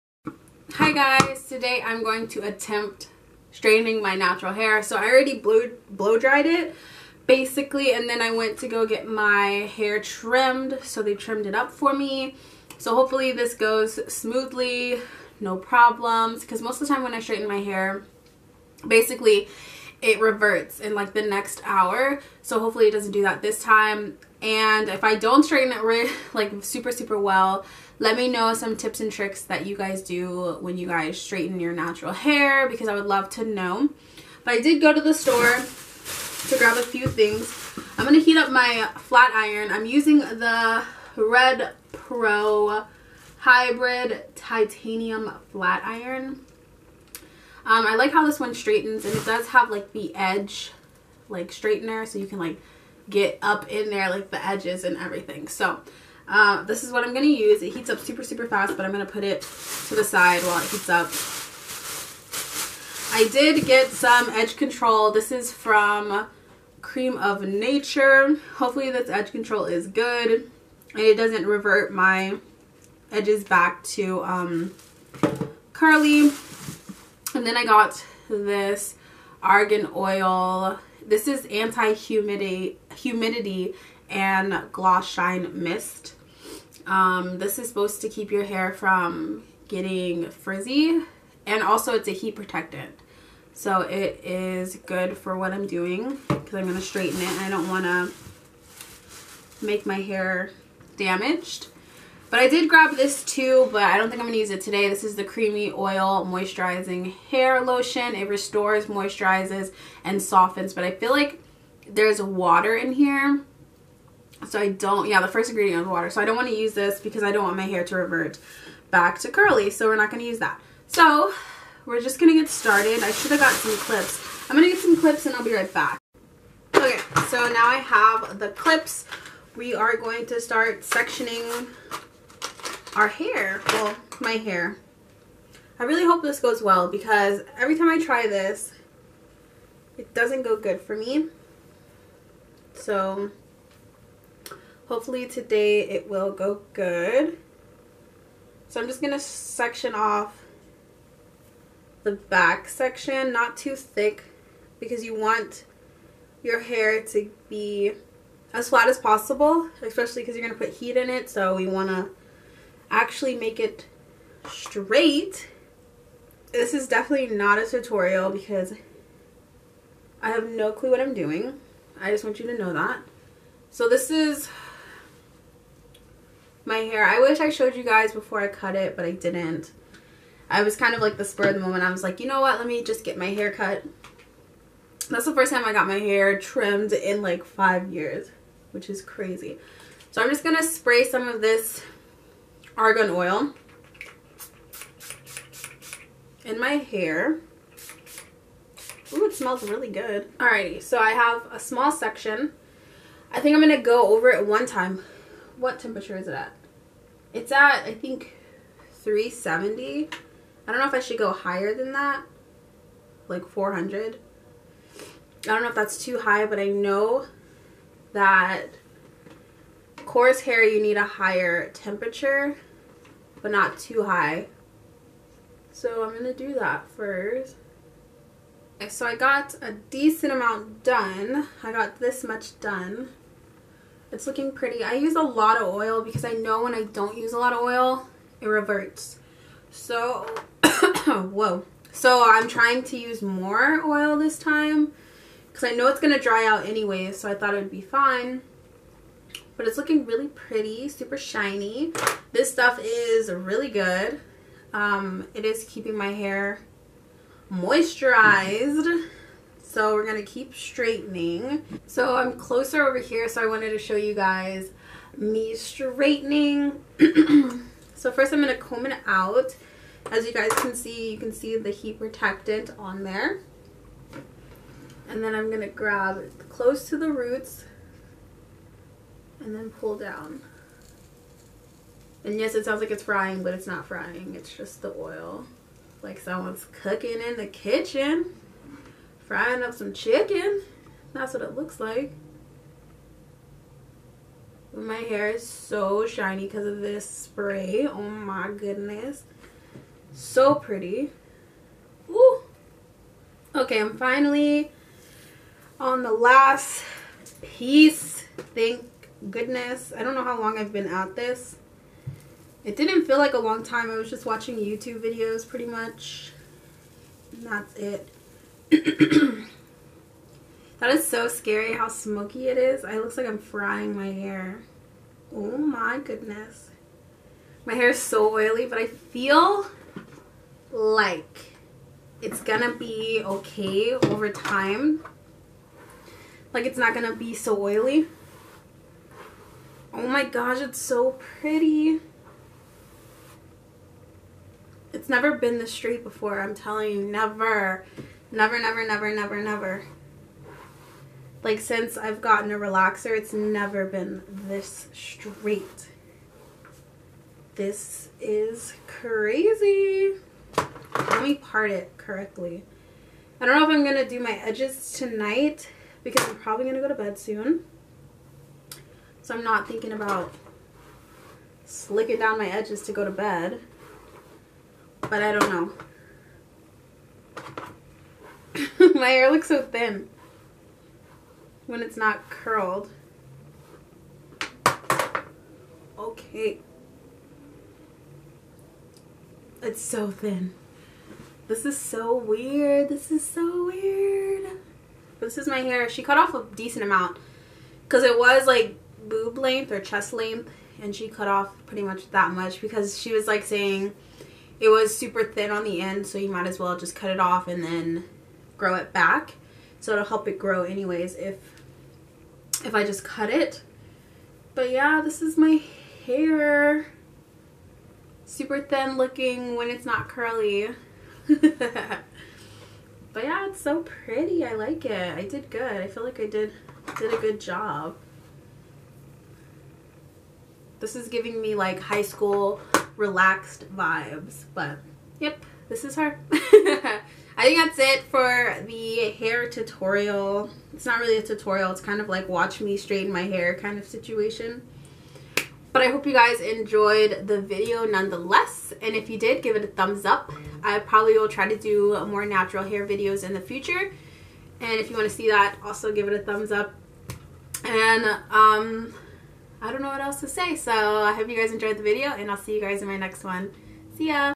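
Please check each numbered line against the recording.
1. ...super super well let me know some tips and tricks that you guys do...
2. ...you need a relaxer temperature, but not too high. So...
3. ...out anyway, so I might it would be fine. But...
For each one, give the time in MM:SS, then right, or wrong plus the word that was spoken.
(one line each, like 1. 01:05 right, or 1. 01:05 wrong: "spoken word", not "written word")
1. 00:26 right
2. 03:40 wrong: "higher", not "relaxer"
3. 04:06 wrong: "thought", not "might".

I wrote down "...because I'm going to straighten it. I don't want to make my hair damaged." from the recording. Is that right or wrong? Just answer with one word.
right.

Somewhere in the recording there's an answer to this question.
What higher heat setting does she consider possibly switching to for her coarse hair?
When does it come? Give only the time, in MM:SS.
03:33.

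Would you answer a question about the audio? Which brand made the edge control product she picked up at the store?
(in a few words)
Creme of Nature.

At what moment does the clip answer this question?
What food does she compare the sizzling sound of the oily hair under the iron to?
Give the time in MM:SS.
04:49.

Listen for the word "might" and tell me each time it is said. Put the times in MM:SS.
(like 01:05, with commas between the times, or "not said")
06:46.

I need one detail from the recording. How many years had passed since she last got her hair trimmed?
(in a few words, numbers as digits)
5 years.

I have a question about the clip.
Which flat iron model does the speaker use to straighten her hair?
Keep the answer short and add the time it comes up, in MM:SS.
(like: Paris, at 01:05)
Red Pro Hybrid Titanium, at 00:41.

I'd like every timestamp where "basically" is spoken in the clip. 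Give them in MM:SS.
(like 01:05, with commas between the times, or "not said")
00:07, 00:18.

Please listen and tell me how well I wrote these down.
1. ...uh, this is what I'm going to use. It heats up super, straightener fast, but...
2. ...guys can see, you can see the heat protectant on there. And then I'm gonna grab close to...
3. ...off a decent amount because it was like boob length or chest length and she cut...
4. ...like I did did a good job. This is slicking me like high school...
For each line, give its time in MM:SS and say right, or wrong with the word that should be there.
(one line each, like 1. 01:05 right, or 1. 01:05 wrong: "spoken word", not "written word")
1. 00:56 wrong: "super", not "straightener"
2. 04:30 right
3. 06:36 right
4. 07:06 wrong: "giving", not "slicking".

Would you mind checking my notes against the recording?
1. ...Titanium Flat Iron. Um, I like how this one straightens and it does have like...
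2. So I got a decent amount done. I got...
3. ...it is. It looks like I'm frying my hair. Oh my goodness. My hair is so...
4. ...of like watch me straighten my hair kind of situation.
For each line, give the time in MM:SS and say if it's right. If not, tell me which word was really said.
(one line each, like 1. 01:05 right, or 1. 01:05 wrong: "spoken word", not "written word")
1. 00:44 right
2. 03:48 right
3. 05:22 right
4. 07:21 right.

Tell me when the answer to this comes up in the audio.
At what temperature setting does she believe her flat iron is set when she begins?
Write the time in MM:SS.
03:28.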